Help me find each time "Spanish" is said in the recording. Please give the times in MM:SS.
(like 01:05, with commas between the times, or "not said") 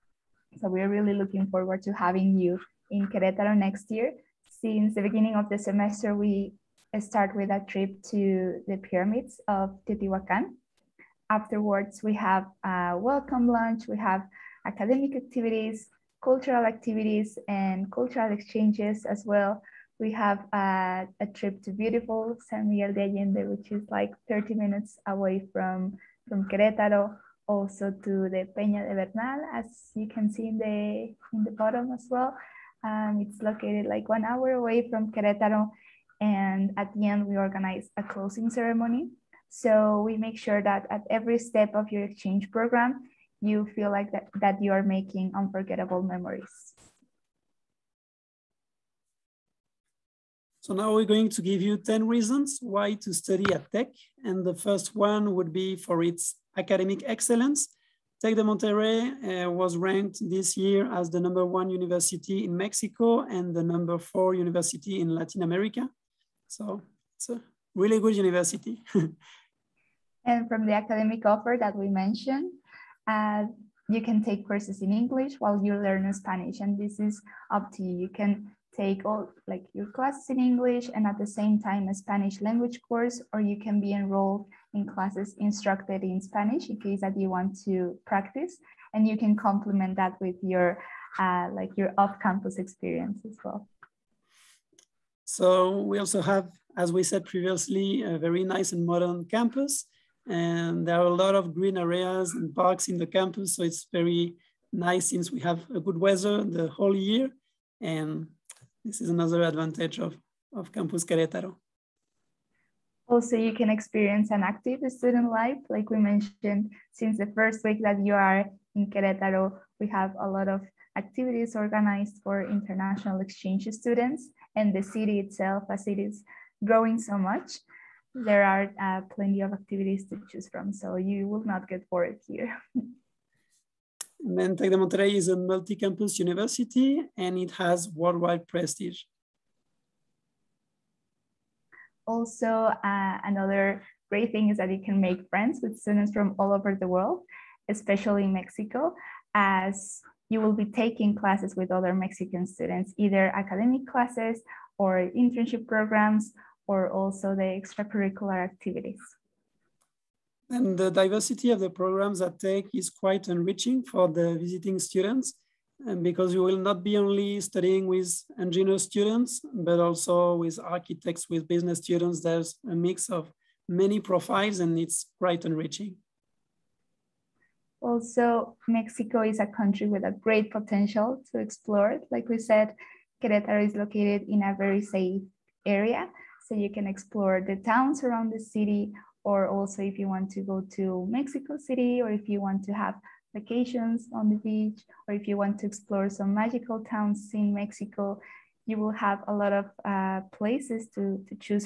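01:16, 01:21, 01:26.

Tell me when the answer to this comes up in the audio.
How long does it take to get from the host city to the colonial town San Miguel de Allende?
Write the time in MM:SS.
00:24.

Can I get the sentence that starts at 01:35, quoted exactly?
So we also have, as we said previously, a very nice and modern campus.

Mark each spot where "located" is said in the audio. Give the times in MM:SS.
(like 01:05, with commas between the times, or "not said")
00:33, 03:03.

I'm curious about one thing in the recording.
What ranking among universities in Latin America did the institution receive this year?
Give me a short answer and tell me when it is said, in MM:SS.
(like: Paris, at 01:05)
number 4, at 01:03.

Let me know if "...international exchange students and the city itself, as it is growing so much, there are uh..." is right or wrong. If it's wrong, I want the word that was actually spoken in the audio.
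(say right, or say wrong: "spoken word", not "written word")
right.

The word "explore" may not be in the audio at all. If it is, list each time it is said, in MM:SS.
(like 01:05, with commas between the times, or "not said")
03:01, 03:06, 03:15.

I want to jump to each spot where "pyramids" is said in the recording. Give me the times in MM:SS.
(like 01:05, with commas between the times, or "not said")
00:08.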